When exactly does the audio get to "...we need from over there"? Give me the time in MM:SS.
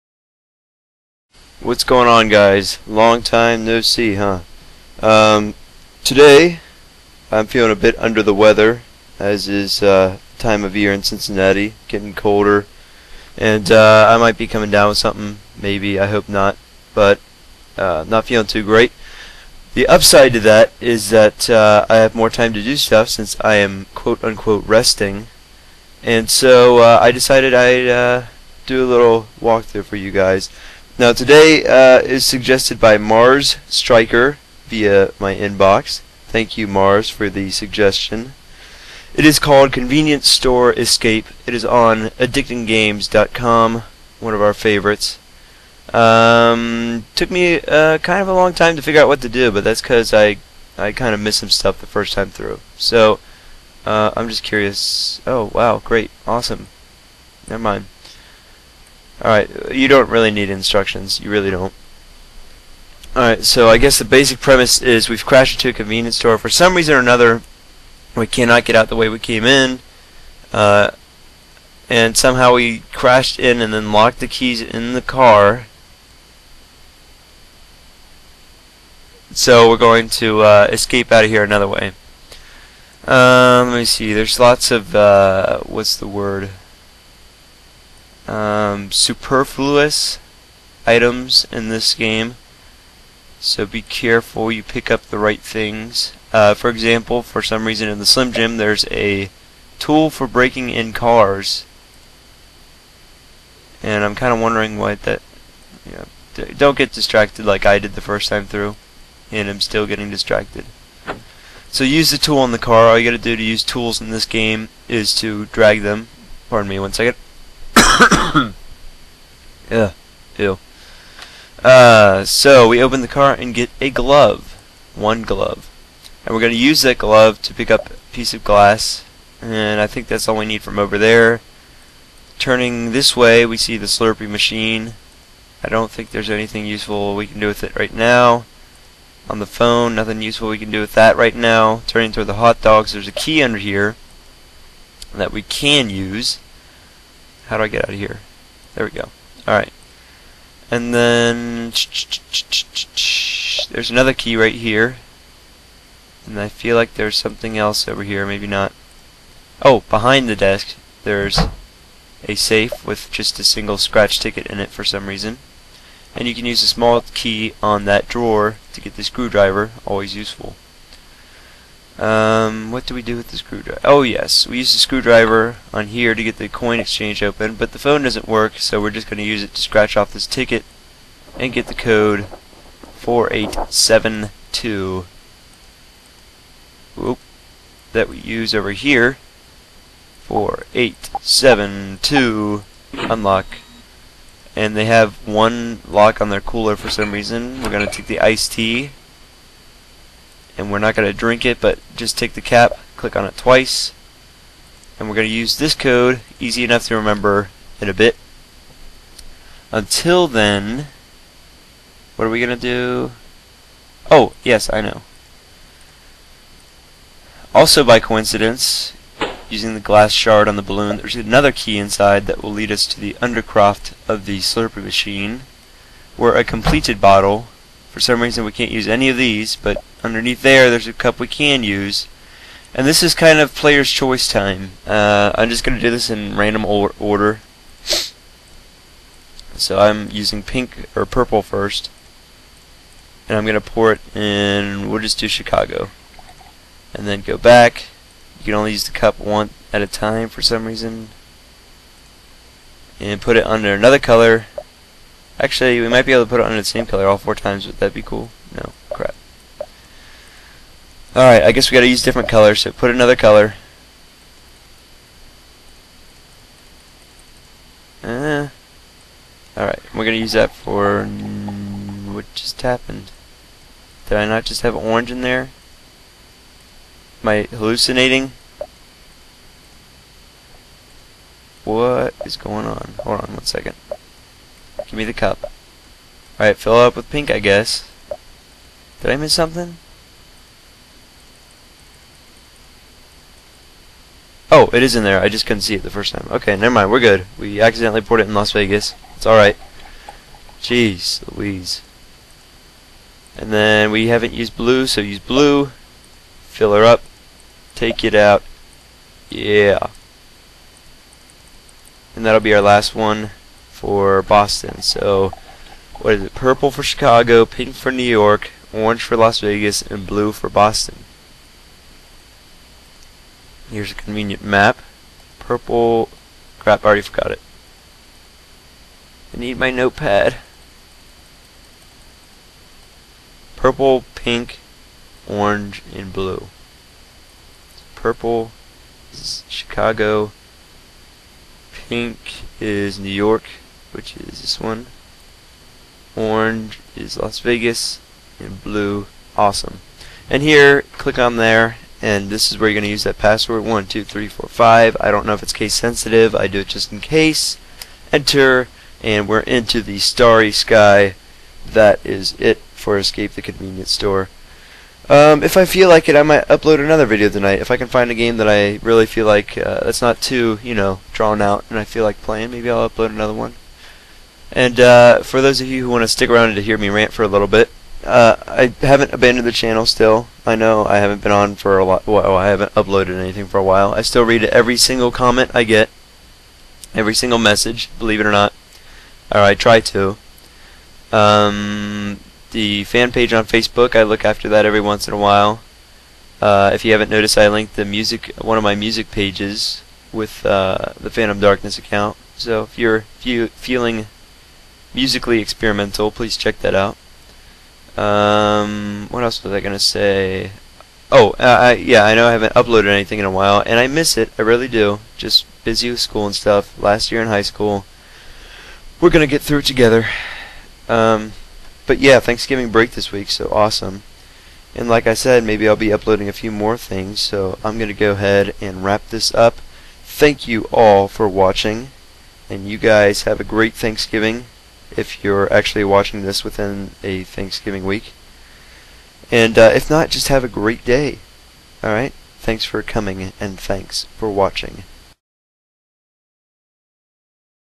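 02:10.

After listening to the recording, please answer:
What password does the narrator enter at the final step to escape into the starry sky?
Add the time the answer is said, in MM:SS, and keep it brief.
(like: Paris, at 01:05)
12345, at 05:53.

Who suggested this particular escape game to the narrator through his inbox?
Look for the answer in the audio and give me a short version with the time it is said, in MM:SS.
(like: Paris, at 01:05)
Mars Striker, at 00:32.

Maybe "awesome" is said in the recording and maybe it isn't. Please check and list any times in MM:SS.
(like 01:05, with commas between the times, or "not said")
00:56, 05:49, 07:03.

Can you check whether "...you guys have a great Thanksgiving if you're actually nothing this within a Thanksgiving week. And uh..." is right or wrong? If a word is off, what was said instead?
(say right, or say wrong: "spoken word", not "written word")
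wrong: "watching", not "nothing".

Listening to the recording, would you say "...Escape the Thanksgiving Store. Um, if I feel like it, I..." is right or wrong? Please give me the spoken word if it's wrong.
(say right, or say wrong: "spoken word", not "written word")
wrong: "Convenience", not "Thanksgiving".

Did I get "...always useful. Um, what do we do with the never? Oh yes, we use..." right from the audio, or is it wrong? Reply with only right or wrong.
wrong.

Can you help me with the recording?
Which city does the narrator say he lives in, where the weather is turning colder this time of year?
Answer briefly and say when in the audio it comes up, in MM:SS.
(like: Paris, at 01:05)
Cincinnati, at 00:11.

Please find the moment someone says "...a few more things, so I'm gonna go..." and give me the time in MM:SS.
07:06.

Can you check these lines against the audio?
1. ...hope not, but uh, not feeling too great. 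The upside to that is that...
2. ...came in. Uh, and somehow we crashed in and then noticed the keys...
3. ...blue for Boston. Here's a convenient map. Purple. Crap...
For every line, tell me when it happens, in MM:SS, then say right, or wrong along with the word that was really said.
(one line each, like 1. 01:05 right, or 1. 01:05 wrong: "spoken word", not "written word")
1. 00:16 right
2. 01:09 wrong: "locked", not "noticed"
3. 05:20 right.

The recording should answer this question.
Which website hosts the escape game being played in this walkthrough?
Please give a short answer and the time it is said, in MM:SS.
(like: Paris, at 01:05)
addictinggames.com, at 00:42.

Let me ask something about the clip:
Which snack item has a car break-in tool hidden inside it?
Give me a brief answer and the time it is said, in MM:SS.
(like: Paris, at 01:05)
Slim Jim, at 01:38.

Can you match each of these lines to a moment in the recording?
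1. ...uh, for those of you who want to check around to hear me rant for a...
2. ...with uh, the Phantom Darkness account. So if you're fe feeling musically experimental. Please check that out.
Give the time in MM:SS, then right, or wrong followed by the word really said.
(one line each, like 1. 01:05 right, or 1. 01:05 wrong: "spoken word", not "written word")
1. 06:14 wrong: "stick", not "check"
2. 06:40 right.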